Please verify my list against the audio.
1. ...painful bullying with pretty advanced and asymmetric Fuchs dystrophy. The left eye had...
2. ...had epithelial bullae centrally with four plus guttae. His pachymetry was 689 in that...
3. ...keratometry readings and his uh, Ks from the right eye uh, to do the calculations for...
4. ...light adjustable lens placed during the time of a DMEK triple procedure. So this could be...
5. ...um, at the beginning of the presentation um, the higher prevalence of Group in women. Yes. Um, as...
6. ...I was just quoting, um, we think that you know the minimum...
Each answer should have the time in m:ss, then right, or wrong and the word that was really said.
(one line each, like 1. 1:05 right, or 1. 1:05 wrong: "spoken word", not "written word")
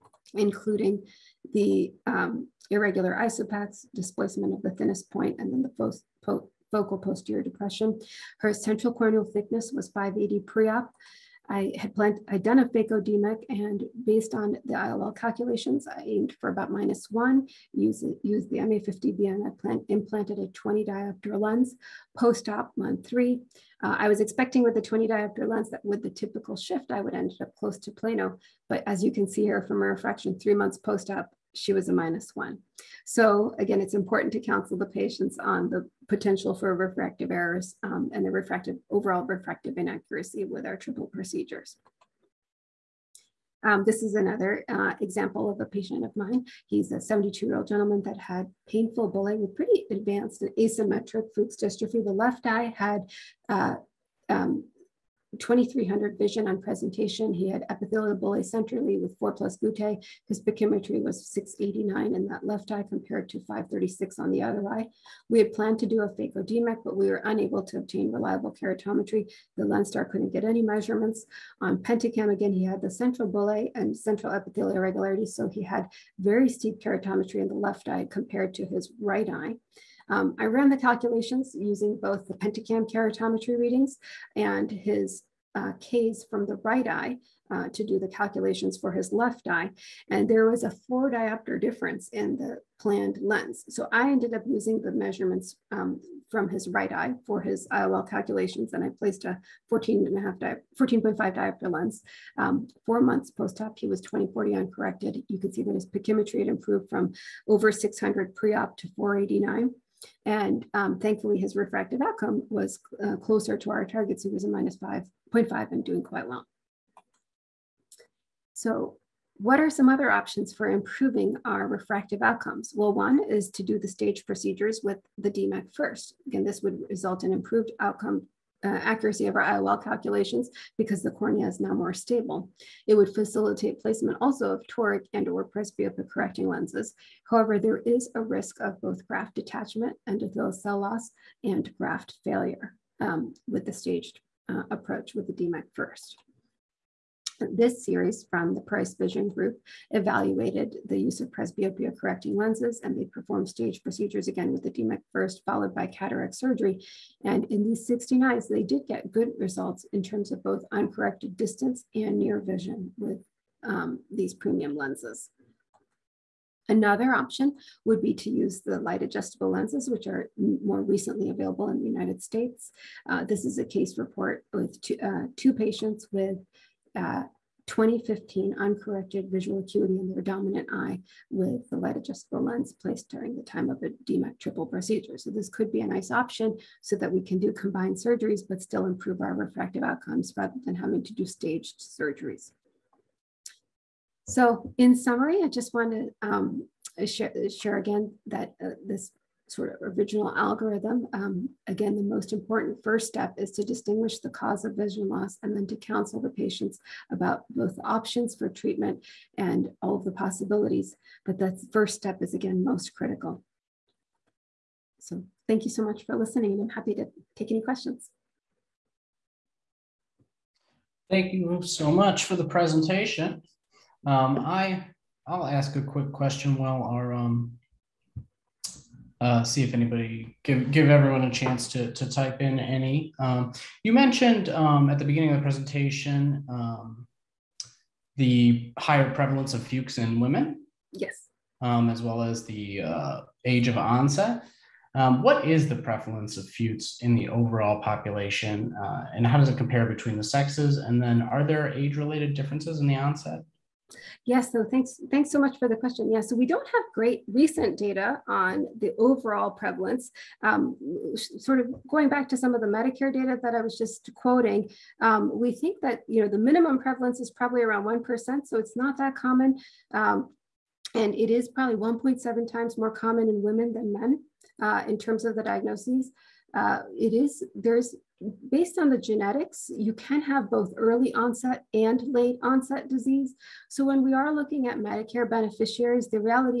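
1. 0:48 right
2. 0:57 right
3. 1:22 right
4. 3:01 right
5. 3:54 wrong: "Fuchs", not "Group"
6. 4:23 right.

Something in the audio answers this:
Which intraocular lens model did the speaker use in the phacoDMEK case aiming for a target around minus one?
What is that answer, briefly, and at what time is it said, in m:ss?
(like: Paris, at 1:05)
MA50B, at 0:18.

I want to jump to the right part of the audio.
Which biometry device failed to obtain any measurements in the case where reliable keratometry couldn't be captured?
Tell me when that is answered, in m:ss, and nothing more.
1:09.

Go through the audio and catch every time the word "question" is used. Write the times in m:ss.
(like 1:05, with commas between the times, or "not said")
3:37, 3:46, 4:15.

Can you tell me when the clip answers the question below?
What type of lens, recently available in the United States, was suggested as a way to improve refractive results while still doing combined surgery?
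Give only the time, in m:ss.
2:48.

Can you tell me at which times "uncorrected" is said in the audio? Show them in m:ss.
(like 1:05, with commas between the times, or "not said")
1:44, 2:40, 2:58.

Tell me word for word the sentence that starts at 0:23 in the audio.
Uh, I was expecting with the 20 diopter lens that with the typical shift, I would end up close to Plano.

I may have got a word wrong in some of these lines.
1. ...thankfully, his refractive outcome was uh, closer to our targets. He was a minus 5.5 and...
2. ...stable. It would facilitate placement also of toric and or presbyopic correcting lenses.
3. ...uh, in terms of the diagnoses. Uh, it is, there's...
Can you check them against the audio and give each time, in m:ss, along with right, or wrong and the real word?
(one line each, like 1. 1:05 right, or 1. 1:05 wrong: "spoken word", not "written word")
1. 1:50 right
2. 2:11 right
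3. 4:34 right.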